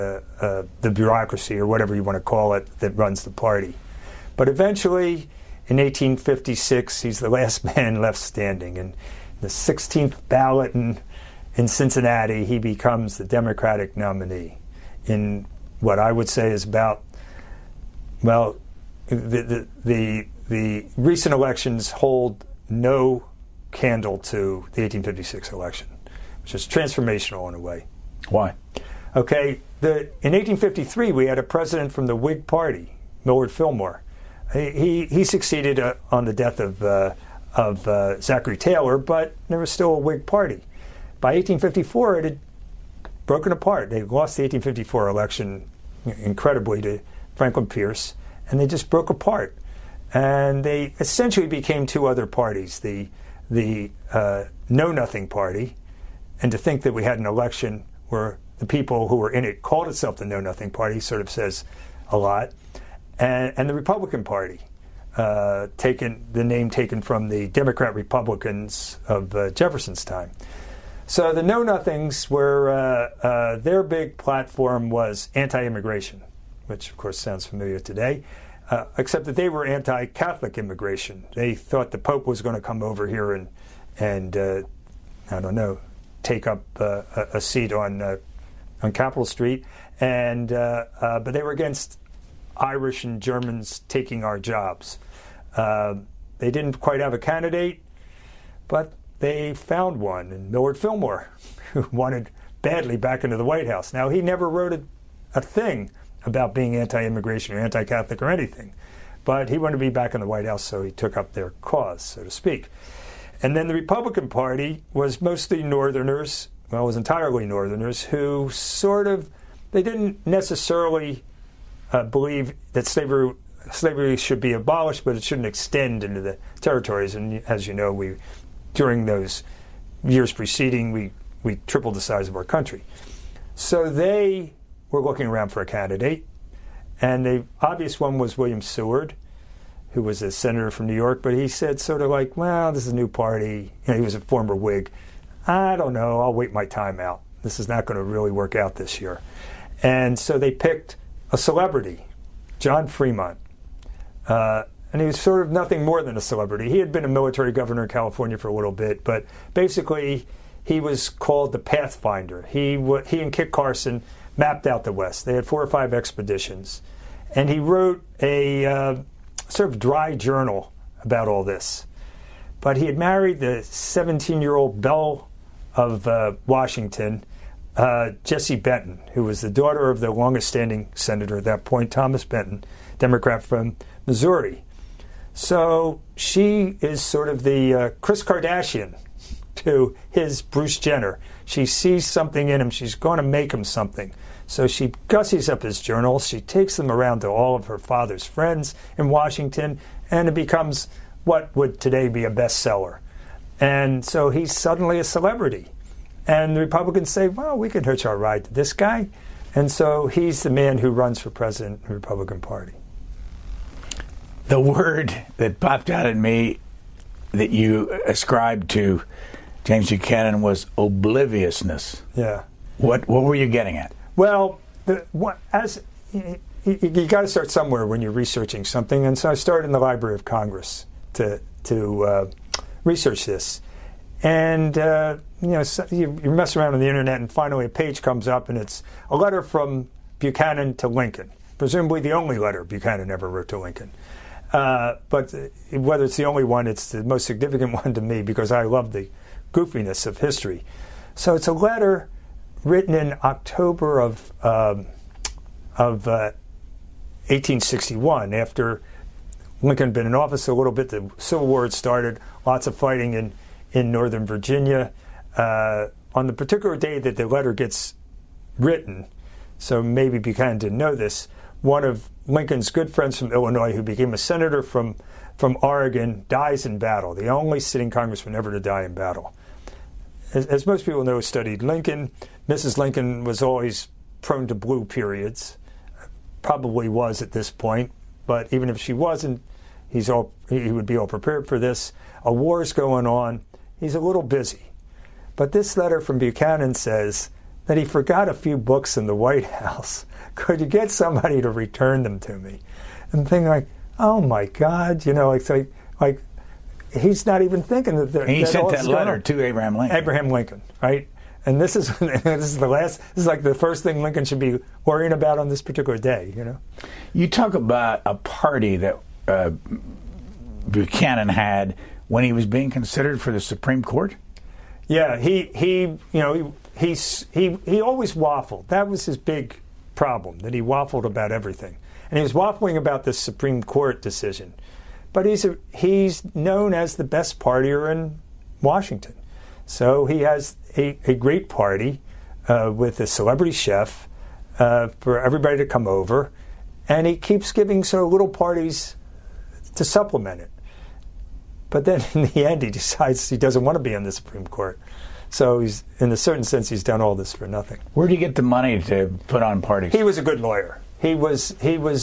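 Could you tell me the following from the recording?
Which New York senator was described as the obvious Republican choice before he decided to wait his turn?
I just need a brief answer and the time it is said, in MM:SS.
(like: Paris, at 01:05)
William Seward, at 02:18.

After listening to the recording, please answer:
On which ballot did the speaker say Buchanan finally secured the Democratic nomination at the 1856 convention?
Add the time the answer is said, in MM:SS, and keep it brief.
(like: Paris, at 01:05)
16th, at 00:09.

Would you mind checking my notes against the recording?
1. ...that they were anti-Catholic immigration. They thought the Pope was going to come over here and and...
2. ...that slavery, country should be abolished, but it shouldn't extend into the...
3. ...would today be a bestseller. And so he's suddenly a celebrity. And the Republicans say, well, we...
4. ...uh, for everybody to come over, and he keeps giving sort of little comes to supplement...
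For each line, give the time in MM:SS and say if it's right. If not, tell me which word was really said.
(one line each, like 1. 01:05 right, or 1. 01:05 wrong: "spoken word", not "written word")
1. 01:19 right
2. 02:02 wrong: "slavery", not "country"
3. 03:21 right
4. 05:44 wrong: "parties", not "comes".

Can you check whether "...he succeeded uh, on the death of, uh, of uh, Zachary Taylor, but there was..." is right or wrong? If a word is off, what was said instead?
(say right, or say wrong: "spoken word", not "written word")
right.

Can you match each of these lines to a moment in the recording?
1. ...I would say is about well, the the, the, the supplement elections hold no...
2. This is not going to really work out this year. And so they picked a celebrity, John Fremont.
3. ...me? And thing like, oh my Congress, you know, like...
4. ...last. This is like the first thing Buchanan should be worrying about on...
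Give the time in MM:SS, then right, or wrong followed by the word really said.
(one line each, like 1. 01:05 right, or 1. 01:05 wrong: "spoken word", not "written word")
1. 00:15 wrong: "recent", not "supplement"
2. 02:27 right
3. 05:02 wrong: "God", not "Congress"
4. 05:12 wrong: "Lincoln", not "Buchanan".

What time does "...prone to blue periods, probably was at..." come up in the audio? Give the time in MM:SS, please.
04:44.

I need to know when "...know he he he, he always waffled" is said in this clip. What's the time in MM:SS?
05:26.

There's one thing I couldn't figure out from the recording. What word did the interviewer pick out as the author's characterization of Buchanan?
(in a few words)
obliviousness.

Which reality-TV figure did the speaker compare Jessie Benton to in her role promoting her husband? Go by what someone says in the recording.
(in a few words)
Kris Kardashian.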